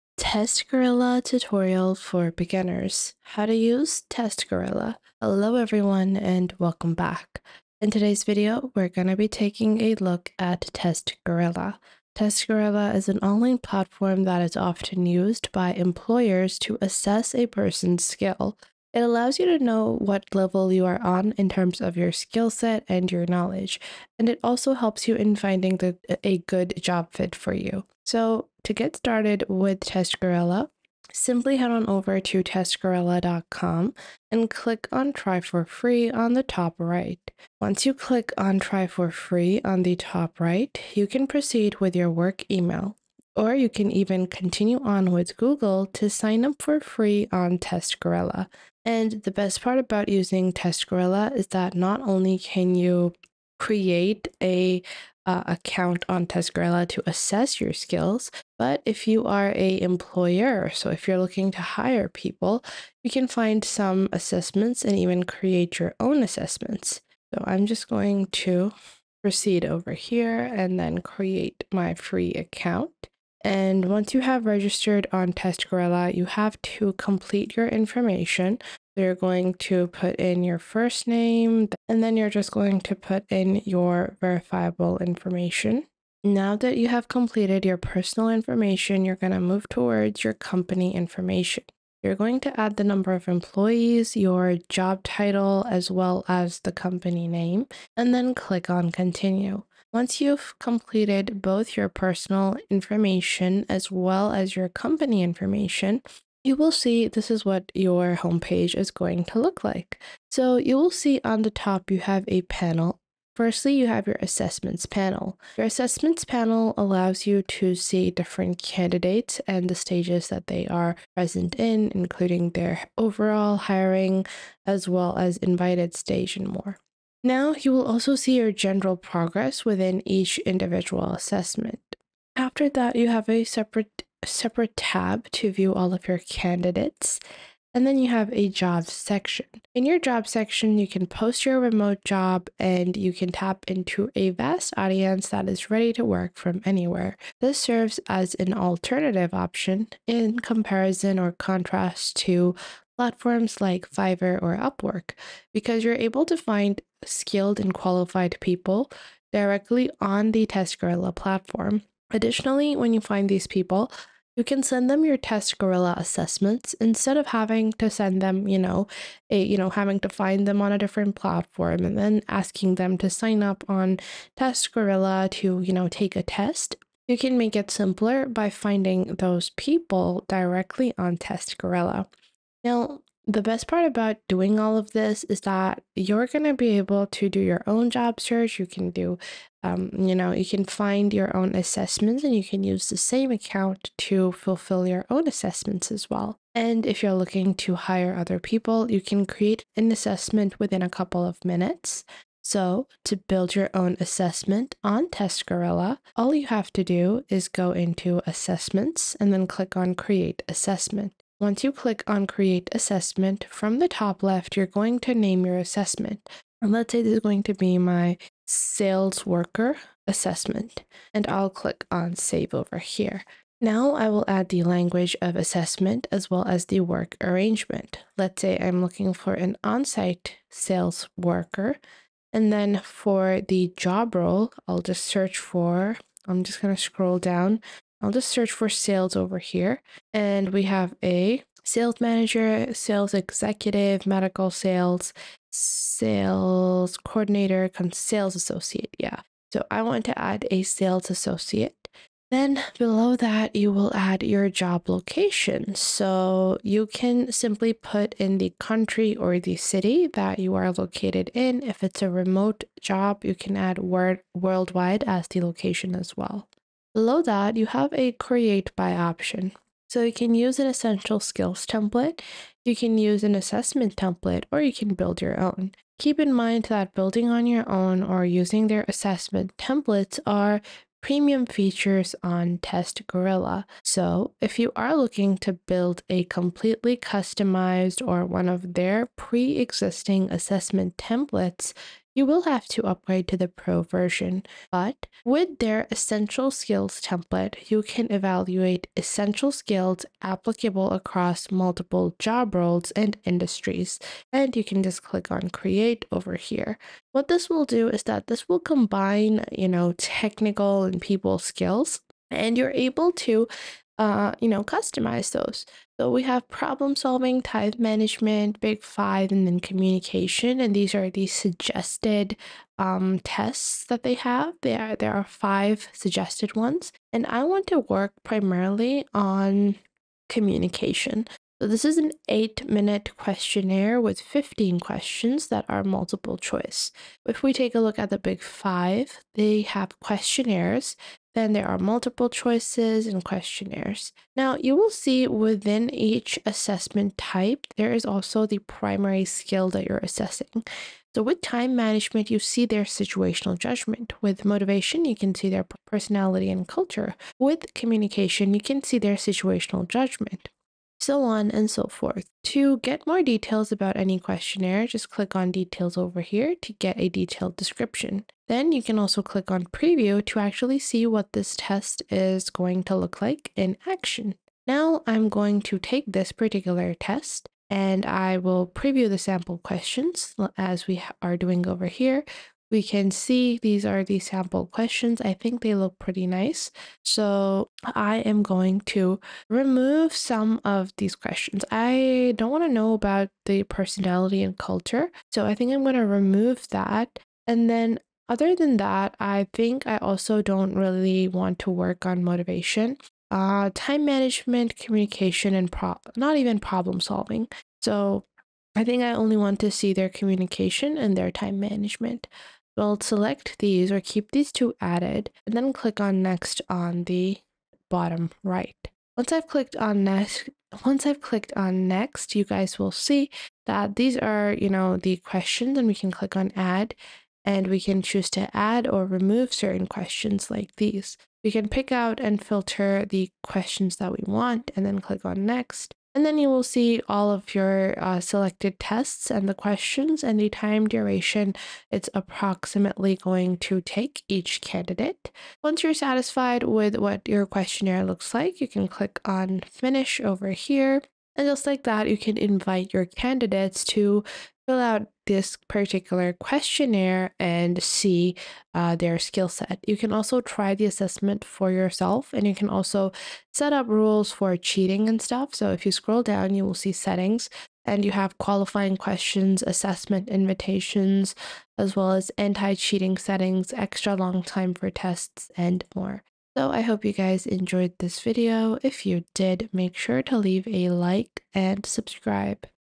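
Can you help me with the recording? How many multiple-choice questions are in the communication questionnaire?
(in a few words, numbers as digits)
15.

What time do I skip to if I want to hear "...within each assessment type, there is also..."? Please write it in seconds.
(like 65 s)
345 s.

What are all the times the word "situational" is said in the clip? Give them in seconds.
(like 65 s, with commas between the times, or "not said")
352 s, 359 s.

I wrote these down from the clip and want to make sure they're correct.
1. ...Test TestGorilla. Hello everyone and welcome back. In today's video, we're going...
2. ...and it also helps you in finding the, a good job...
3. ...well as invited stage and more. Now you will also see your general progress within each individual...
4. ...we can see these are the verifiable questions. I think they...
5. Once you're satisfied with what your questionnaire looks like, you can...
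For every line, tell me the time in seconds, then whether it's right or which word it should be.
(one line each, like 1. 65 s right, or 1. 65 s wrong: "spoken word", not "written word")
1. 4 s wrong: "Gorilla", not "TestGorilla"
2. 24 s right
3. 124 s right
4. 382 s wrong: "sample", not "verifiable"
5. 445 s right.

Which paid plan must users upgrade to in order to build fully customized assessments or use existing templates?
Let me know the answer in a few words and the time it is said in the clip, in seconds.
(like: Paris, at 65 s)
Pro version, at 293 s.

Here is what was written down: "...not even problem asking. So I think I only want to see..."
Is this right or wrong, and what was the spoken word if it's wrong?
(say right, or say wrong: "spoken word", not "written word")
wrong: "solving", not "asking".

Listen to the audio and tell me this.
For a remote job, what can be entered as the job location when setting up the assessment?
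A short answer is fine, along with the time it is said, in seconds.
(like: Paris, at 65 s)
worldwide, at 264 s.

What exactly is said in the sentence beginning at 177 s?
You can make it simpler by finding those people directly on Test Gorilla.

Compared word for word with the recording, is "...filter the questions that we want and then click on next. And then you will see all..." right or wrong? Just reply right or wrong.
right.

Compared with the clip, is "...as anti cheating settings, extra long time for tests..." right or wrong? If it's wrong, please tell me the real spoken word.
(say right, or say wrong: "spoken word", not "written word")
right.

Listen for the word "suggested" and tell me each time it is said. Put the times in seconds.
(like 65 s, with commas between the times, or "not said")
321 s, 325 s.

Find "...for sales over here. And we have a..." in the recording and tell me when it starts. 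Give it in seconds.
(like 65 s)
238 s.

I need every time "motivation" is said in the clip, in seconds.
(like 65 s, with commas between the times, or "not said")
354 s, 402 s.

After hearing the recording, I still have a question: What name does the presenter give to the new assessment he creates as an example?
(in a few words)
sales worker assessment.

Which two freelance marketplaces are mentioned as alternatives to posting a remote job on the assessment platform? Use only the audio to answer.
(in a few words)
Fiverr or Upwork.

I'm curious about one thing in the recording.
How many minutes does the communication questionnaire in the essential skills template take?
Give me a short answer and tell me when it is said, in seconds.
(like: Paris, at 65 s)
8, at 332 s.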